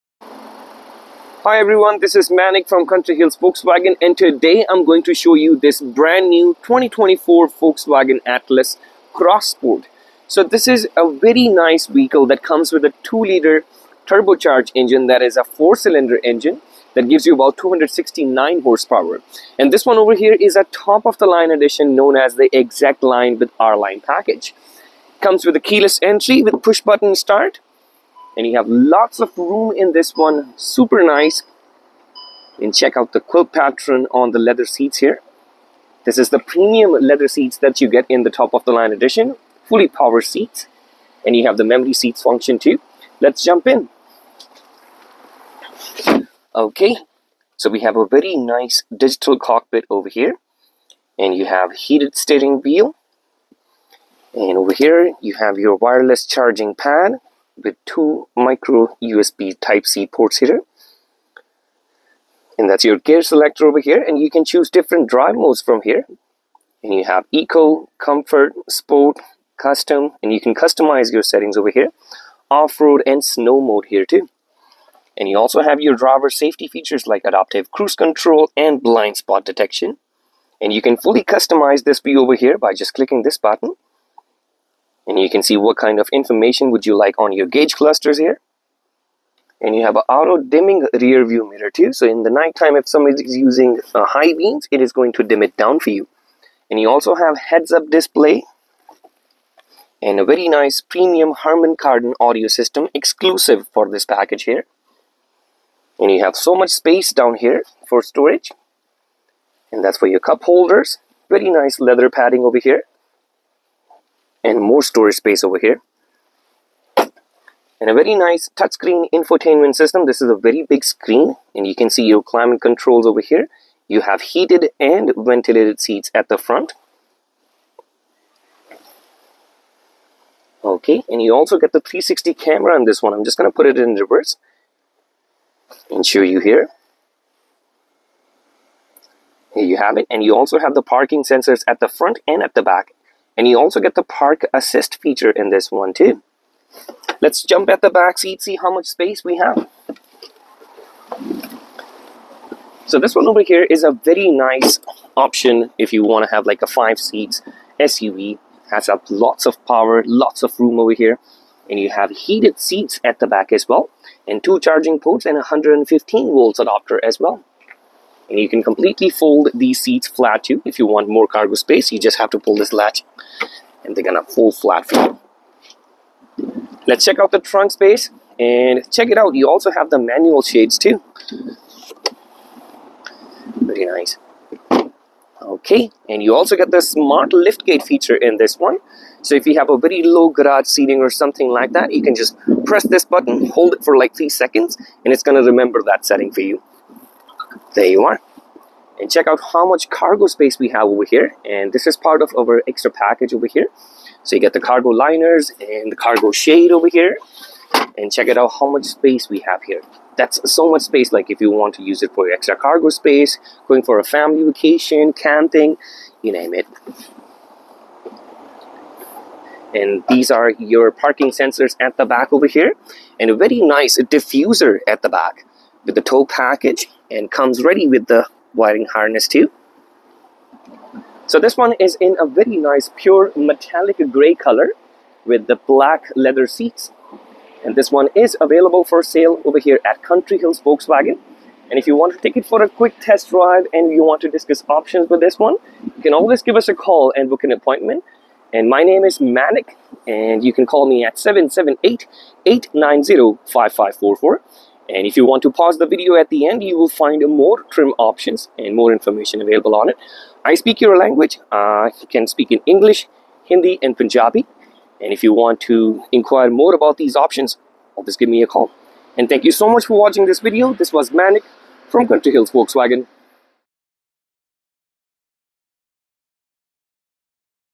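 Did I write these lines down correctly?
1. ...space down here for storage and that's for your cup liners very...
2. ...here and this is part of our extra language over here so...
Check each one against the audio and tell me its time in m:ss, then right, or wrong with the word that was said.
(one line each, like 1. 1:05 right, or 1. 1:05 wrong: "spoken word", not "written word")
1. 1:46 wrong: "holders", not "liners"
2. 3:21 wrong: "package", not "language".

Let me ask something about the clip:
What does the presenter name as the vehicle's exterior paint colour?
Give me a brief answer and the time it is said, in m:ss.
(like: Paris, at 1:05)
Pure metallic gray, at 3:52.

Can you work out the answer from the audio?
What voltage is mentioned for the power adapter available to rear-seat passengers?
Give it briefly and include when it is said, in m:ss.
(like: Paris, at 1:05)
115 volts, at 2:45.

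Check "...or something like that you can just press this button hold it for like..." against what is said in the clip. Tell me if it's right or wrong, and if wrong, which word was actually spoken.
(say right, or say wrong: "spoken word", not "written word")
right.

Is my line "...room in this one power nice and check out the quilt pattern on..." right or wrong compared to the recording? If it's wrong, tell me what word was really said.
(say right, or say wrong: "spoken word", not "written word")
wrong: "super", not "power".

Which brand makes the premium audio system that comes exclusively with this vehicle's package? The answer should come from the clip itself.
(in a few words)
Harman Kardon.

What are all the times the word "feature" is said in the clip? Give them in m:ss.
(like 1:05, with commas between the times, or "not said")
1:16, 2:25, 3:07.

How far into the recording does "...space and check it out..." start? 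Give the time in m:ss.
2:57.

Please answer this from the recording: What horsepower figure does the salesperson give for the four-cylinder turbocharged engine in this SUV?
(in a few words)
269.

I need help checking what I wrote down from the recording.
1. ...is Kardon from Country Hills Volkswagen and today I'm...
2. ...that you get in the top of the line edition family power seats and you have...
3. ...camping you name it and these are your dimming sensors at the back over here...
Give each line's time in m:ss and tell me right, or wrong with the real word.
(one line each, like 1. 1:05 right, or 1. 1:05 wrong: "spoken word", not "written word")
1. 0:02 wrong: "Manik", not "Kardon"
2. 0:37 wrong: "fully", not "family"
3. 3:35 wrong: "parking", not "dimming".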